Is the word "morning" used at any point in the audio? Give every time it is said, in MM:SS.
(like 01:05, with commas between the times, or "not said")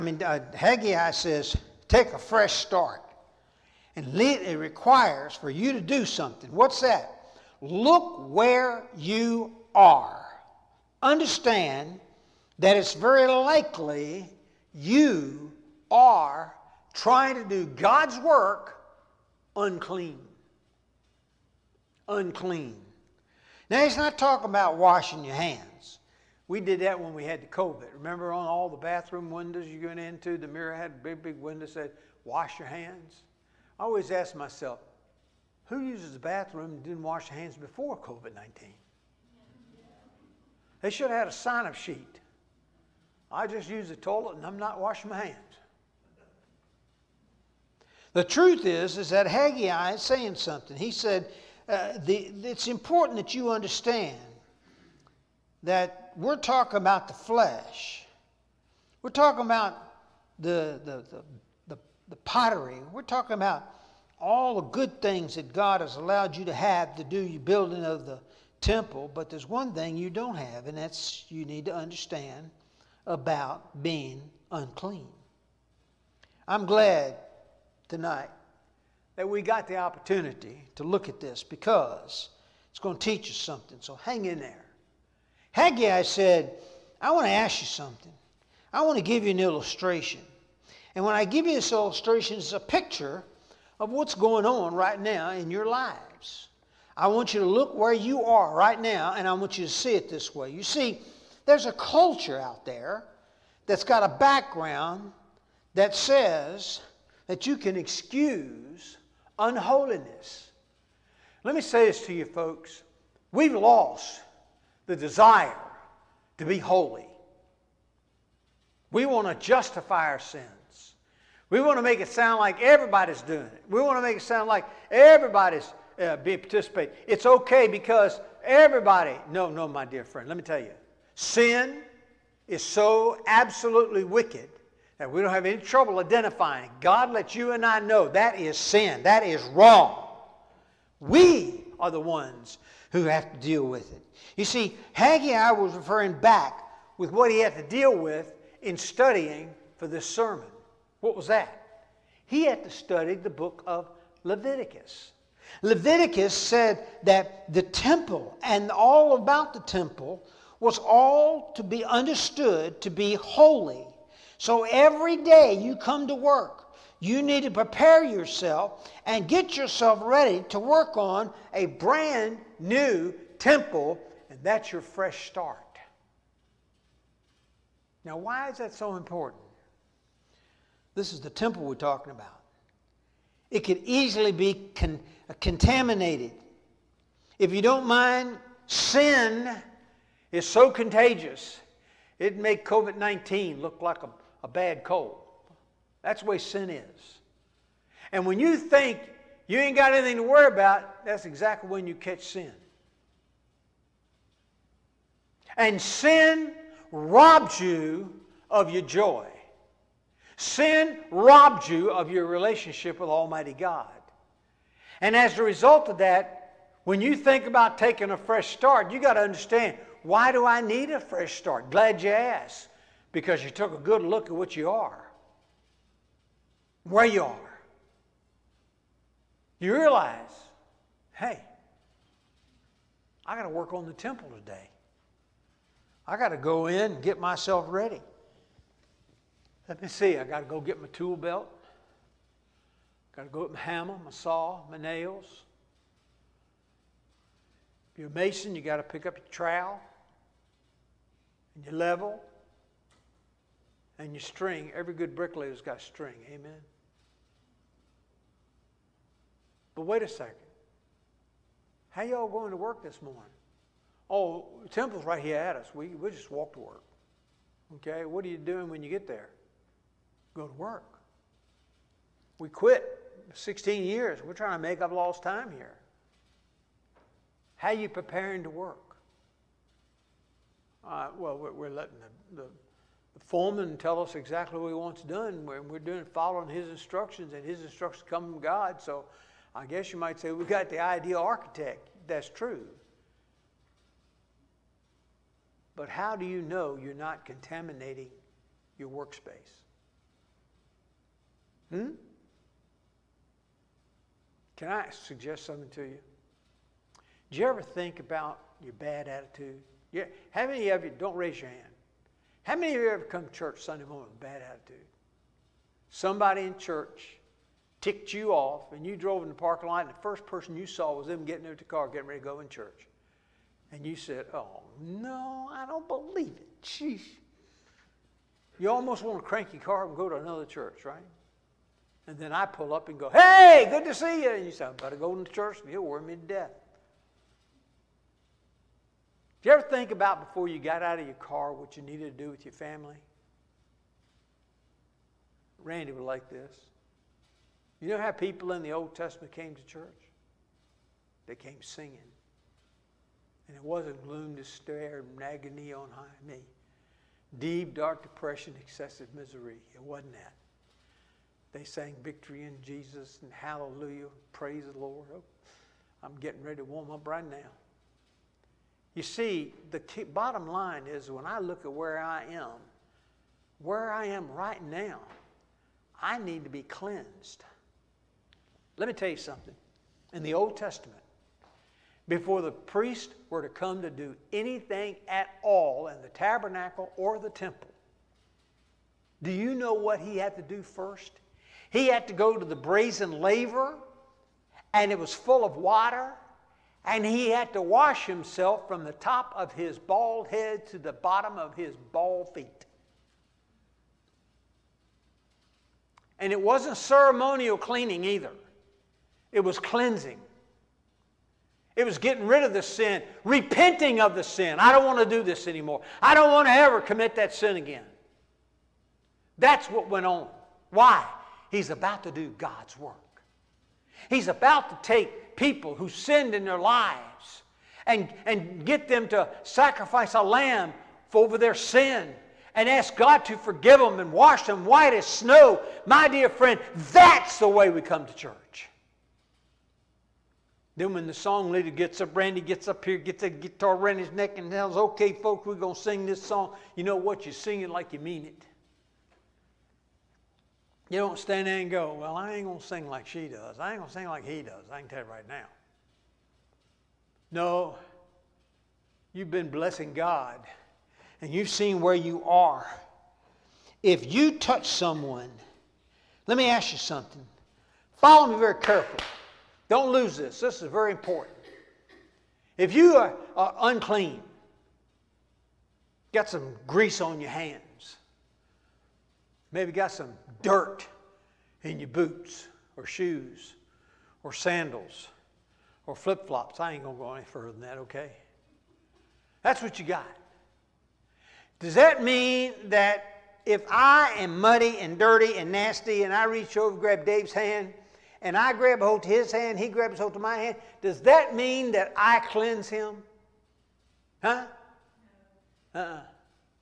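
04:23, 05:13.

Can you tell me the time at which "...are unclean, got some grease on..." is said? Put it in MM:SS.
07:53.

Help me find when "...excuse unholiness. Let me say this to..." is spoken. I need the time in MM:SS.
01:47.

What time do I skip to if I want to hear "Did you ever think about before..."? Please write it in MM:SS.
05:39.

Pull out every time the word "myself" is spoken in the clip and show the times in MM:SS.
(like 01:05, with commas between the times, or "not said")
00:34, 03:57.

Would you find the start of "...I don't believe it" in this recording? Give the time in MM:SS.
05:25.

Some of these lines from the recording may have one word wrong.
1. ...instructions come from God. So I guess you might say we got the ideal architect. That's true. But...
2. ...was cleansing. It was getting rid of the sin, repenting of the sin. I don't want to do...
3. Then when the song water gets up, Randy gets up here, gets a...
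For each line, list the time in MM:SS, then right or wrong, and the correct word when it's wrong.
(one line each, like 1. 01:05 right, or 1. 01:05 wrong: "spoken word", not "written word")
1. 04:47 right
2. 06:49 right
3. 07:20 wrong: "leader", not "water".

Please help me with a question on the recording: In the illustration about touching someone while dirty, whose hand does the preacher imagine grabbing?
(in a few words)
Dave.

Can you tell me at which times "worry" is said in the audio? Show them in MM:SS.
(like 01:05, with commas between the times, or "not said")
03:20, 05:35.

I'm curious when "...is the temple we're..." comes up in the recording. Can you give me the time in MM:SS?
03:01.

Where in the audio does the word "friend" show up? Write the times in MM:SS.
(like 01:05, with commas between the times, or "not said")
02:10, 07:16.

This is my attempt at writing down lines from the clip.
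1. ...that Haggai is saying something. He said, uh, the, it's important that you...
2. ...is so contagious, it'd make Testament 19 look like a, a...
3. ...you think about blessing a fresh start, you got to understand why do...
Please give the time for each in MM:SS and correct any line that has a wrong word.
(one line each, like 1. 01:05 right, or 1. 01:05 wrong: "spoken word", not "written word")
1. 00:49 right
2. 03:10 wrong: "COVID", not "Testament"
3. 03:36 wrong: "taking", not "blessing".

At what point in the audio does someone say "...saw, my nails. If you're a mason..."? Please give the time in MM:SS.
04:04.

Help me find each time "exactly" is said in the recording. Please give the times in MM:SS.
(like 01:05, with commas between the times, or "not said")
03:21, 04:44.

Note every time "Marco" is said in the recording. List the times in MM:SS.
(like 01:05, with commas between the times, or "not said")
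not said.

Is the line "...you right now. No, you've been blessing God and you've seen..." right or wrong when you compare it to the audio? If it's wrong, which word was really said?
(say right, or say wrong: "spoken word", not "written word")
right.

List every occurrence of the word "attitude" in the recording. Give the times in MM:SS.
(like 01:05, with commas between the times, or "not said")
05:09, 05:14.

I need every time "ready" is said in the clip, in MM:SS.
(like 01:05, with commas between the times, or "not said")
02:50, 03:57, 05:22, 06:06.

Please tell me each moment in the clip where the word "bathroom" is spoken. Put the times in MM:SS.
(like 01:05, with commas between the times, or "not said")
00:28, 00:36.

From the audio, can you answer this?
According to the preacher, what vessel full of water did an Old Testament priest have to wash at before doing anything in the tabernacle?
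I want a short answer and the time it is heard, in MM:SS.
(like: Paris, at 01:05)
brazen laver, at 06:32.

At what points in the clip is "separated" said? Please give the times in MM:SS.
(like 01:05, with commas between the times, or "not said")
not said.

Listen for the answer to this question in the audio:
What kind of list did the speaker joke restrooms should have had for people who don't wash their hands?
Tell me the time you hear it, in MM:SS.
00:41.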